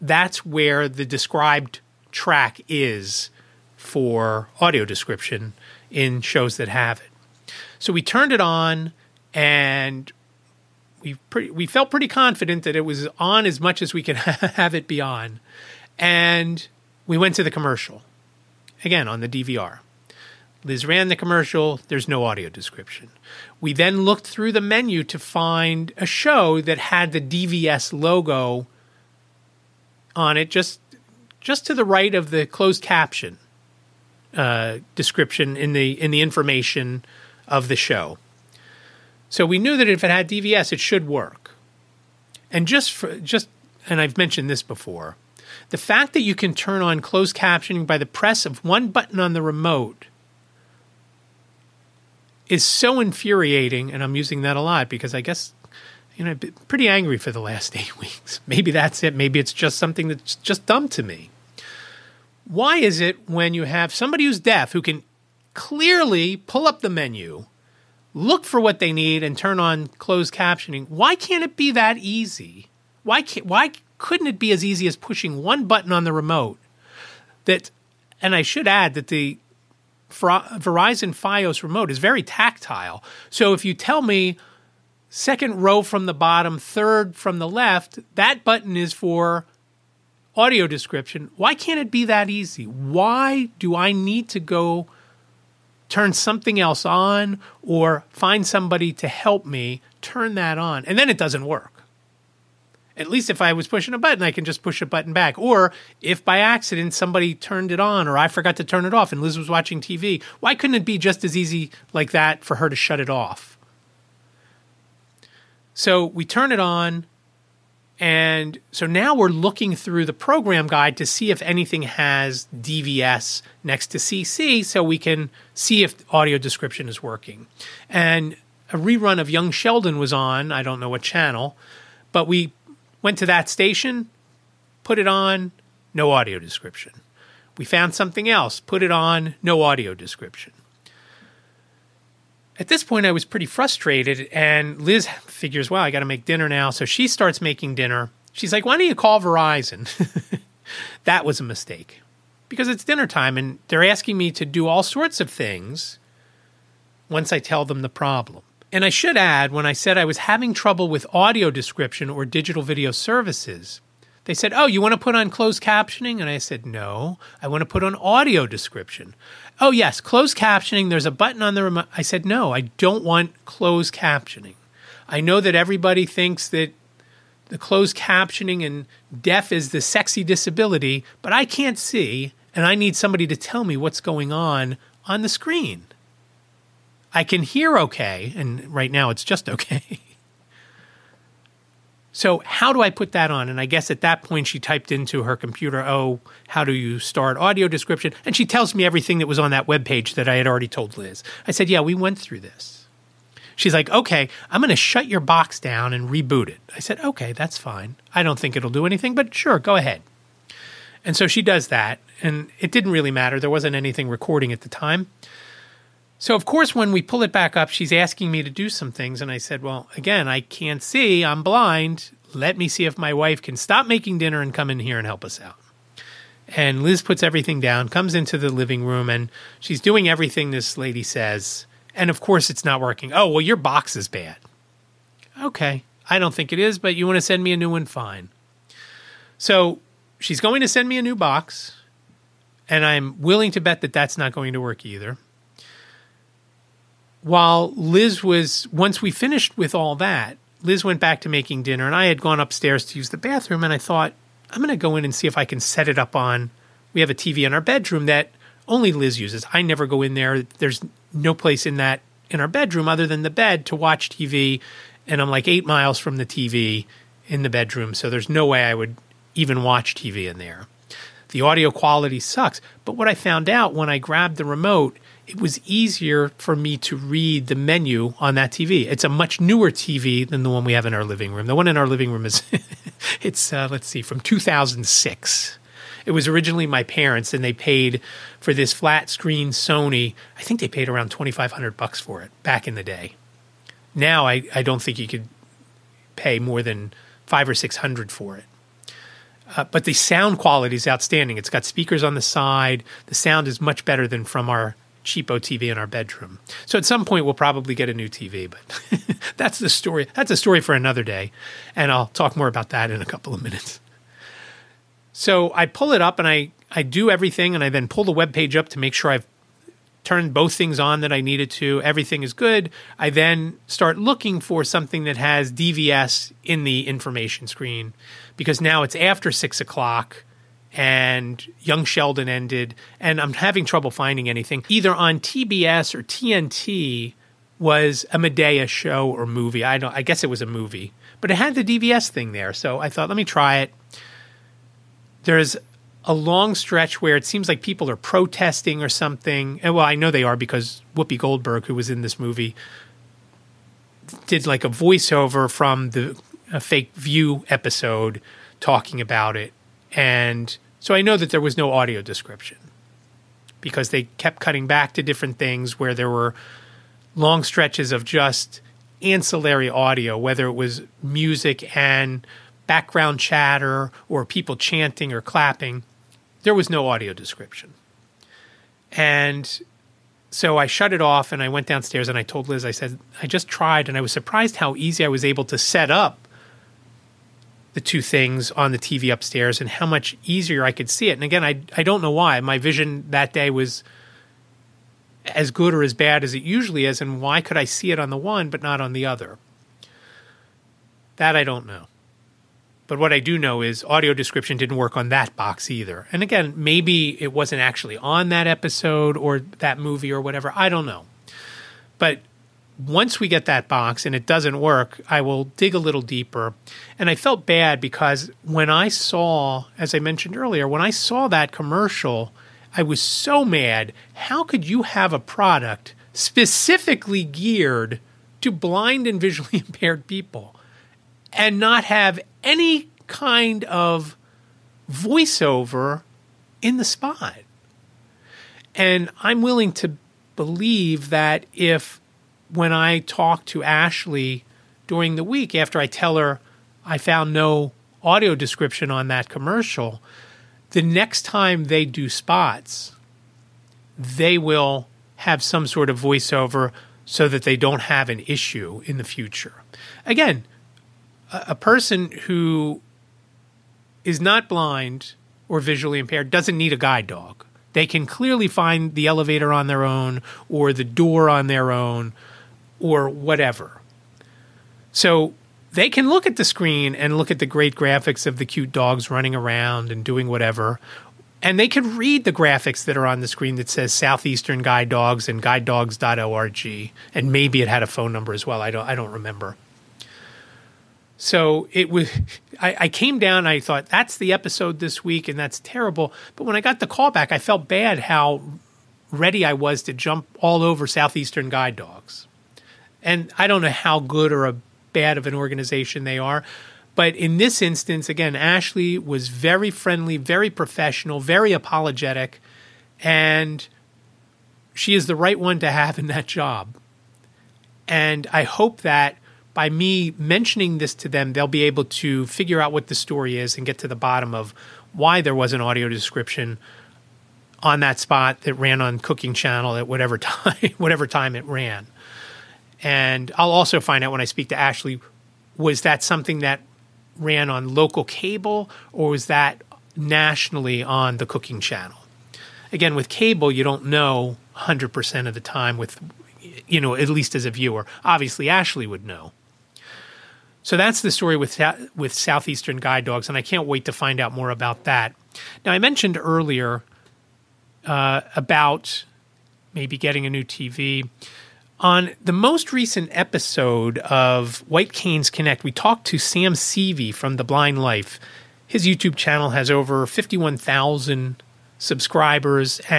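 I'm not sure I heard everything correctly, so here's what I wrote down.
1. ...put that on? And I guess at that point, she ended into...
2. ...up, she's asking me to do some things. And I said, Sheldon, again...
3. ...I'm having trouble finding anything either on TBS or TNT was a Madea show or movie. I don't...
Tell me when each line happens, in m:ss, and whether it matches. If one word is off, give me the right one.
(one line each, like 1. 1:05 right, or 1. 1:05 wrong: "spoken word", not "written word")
1. 3:12 wrong: "typed", not "ended"
2. 3:37 wrong: "Well", not "Sheldon"
3. 5:33 right.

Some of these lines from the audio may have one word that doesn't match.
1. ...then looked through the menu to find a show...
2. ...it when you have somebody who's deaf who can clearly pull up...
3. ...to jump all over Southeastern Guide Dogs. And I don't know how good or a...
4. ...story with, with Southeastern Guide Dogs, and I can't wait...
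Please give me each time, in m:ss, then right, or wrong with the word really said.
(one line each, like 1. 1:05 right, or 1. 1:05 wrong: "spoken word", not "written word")
1. 0:23 right
2. 1:02 right
3. 8:19 right
4. 9:11 right.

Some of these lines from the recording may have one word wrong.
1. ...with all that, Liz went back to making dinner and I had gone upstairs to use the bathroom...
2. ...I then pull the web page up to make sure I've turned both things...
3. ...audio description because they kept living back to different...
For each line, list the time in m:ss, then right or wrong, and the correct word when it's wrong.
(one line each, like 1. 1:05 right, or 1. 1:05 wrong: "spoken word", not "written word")
1. 4:09 right
2. 5:17 right
3. 6:01 wrong: "cutting", not "living".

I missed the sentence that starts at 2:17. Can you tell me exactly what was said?
We found something else, put it on, no audio description.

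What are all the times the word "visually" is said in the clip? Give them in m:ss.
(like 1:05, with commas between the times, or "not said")
7:09, 7:45.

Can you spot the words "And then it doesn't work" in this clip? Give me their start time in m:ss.
1:40.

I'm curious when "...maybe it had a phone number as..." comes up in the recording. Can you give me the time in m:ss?
8:07.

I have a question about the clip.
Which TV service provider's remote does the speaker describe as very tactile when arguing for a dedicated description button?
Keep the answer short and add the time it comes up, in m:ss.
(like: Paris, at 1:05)
Verizon FiOS, at 1:20.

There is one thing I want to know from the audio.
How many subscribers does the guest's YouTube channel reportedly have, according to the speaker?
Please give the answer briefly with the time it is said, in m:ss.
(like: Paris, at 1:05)
over 51,000, at 9:29.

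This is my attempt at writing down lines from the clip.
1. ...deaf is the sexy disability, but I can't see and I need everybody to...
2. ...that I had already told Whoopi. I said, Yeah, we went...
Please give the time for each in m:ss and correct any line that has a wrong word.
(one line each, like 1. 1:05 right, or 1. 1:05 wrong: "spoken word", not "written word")
1. 2:59 wrong: "somebody", not "everybody"
2. 3:20 wrong: "Liz", not "Whoopi".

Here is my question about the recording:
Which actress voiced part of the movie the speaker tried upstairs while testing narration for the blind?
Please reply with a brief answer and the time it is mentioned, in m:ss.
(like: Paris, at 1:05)
Whoopi Goldberg, at 5:50.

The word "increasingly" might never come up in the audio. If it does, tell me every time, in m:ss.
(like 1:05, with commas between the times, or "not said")
not said.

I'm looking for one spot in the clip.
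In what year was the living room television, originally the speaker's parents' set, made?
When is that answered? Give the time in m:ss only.
4:44.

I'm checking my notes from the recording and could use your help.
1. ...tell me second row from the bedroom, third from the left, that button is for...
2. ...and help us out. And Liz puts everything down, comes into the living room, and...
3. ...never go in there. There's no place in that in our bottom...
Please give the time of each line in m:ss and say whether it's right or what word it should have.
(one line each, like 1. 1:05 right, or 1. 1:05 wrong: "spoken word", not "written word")
1. 1:23 wrong: "bottom", not "bedroom"
2. 3:44 right
3. 4:19 wrong: "bedroom", not "bottom".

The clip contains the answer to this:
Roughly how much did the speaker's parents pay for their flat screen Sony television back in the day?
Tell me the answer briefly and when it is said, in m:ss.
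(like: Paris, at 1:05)
$2500, at 4:51.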